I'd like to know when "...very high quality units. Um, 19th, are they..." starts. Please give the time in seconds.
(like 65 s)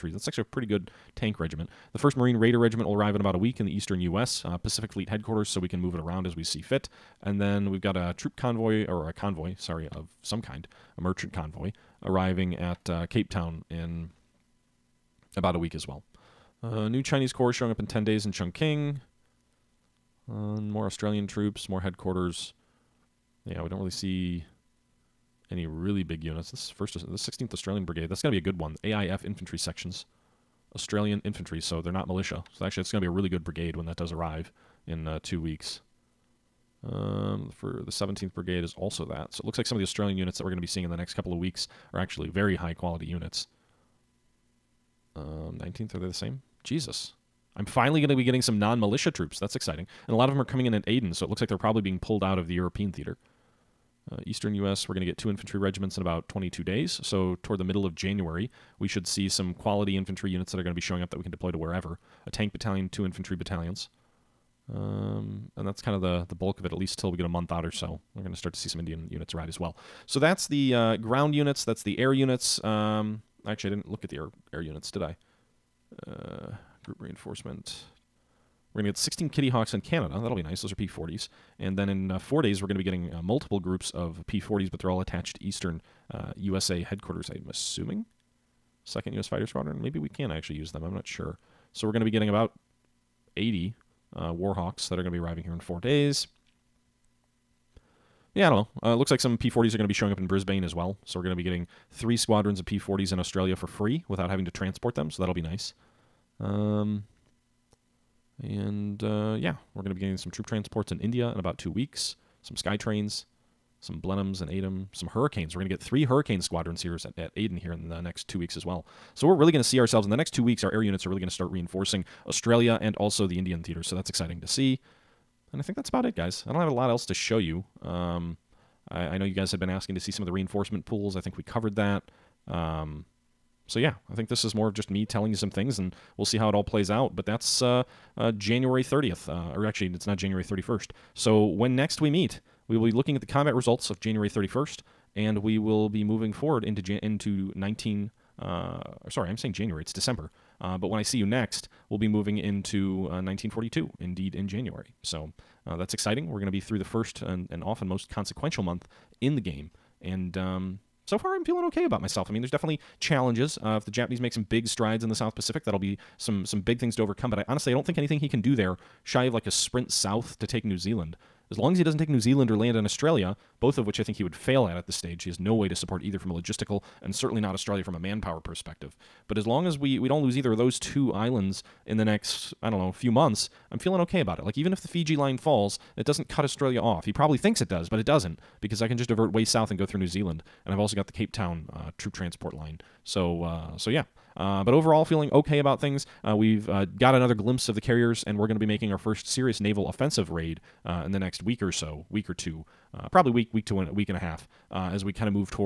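42 s.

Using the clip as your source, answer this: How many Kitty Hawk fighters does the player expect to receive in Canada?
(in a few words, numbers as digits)
16.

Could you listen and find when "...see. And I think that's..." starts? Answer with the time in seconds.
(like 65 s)
124 s.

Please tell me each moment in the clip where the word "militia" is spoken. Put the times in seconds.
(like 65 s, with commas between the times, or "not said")
32 s, 48 s.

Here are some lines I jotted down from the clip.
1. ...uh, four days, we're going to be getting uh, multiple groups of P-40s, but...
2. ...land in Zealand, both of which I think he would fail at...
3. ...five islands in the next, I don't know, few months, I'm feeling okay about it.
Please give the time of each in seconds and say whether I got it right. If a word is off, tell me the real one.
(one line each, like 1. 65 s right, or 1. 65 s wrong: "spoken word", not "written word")
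1. 82 s right
2. 172 s wrong: "Australia", not "Zealand"
3. 180 s wrong: "two", not "five".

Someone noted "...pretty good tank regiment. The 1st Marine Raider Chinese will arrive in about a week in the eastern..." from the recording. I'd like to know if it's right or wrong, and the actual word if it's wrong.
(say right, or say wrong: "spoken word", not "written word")
wrong: "Regiment", not "Chinese".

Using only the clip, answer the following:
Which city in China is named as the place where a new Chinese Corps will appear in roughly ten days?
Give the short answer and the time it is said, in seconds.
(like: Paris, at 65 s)
Chongqing, at 18 s.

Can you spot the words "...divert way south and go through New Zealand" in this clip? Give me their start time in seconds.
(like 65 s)
189 s.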